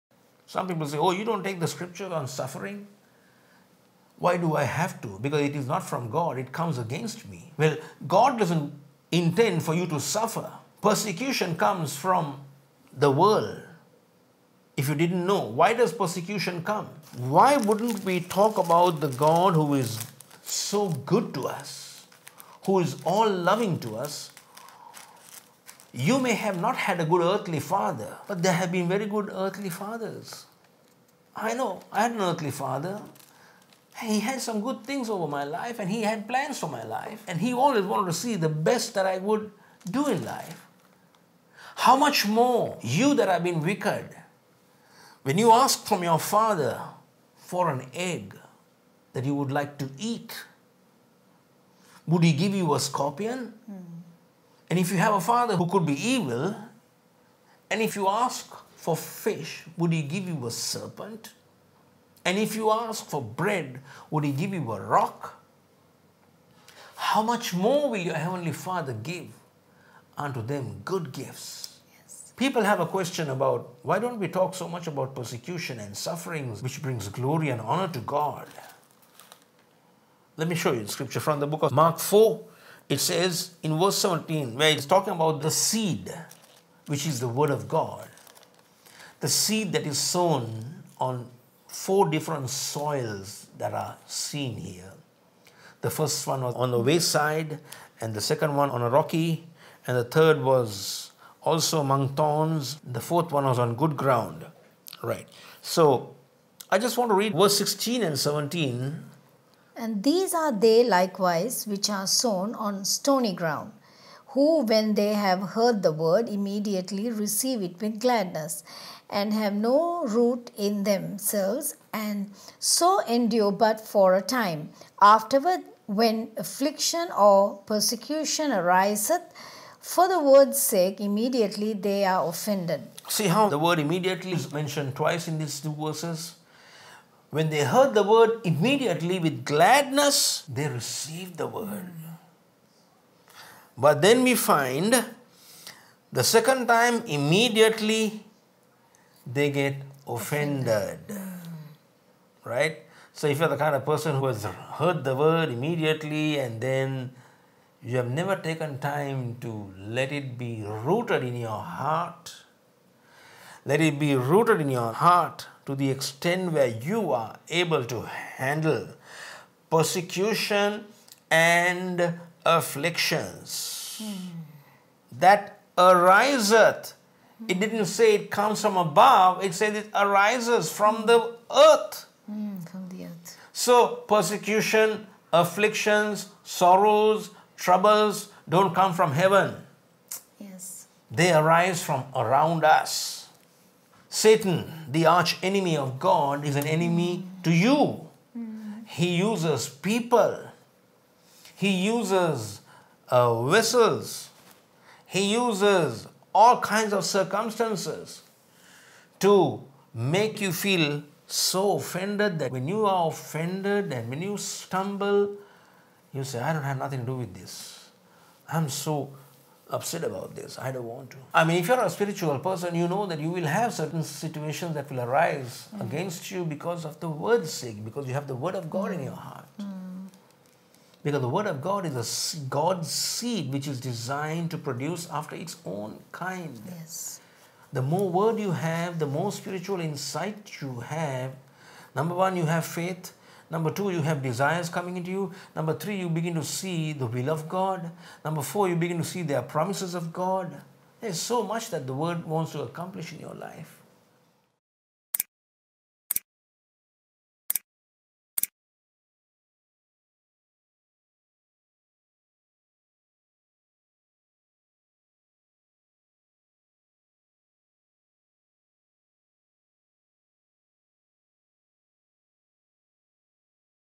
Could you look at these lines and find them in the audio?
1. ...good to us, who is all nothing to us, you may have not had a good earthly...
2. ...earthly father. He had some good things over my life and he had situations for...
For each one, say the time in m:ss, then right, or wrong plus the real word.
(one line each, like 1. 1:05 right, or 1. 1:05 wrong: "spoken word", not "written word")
1. 0:21 wrong: "loving", not "nothing"
2. 0:32 wrong: "plans", not "situations".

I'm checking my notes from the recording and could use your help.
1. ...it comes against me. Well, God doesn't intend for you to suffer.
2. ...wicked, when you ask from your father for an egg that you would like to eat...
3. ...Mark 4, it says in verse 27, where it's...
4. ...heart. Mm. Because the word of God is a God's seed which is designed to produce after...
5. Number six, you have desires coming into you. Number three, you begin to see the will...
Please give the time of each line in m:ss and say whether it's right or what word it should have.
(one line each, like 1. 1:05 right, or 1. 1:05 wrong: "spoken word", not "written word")
1. 0:06 right
2. 0:43 right
3. 1:21 wrong: "17", not "27"
4. 3:49 right
5. 4:03 wrong: "two", not "six".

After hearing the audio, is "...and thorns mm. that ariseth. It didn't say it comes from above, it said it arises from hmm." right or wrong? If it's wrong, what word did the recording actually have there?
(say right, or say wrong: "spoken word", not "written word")
wrong: "afflictions", not "thorns".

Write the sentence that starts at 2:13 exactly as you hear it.
See how the word immediately is mentioned twice in these two verses?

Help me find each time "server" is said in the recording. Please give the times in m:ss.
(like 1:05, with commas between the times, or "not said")
not said.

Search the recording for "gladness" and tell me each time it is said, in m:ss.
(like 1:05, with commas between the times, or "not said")
1:57, 2:19.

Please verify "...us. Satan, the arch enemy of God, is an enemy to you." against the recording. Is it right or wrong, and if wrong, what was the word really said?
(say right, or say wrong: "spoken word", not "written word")
right.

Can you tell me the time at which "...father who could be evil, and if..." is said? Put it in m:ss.
0:55.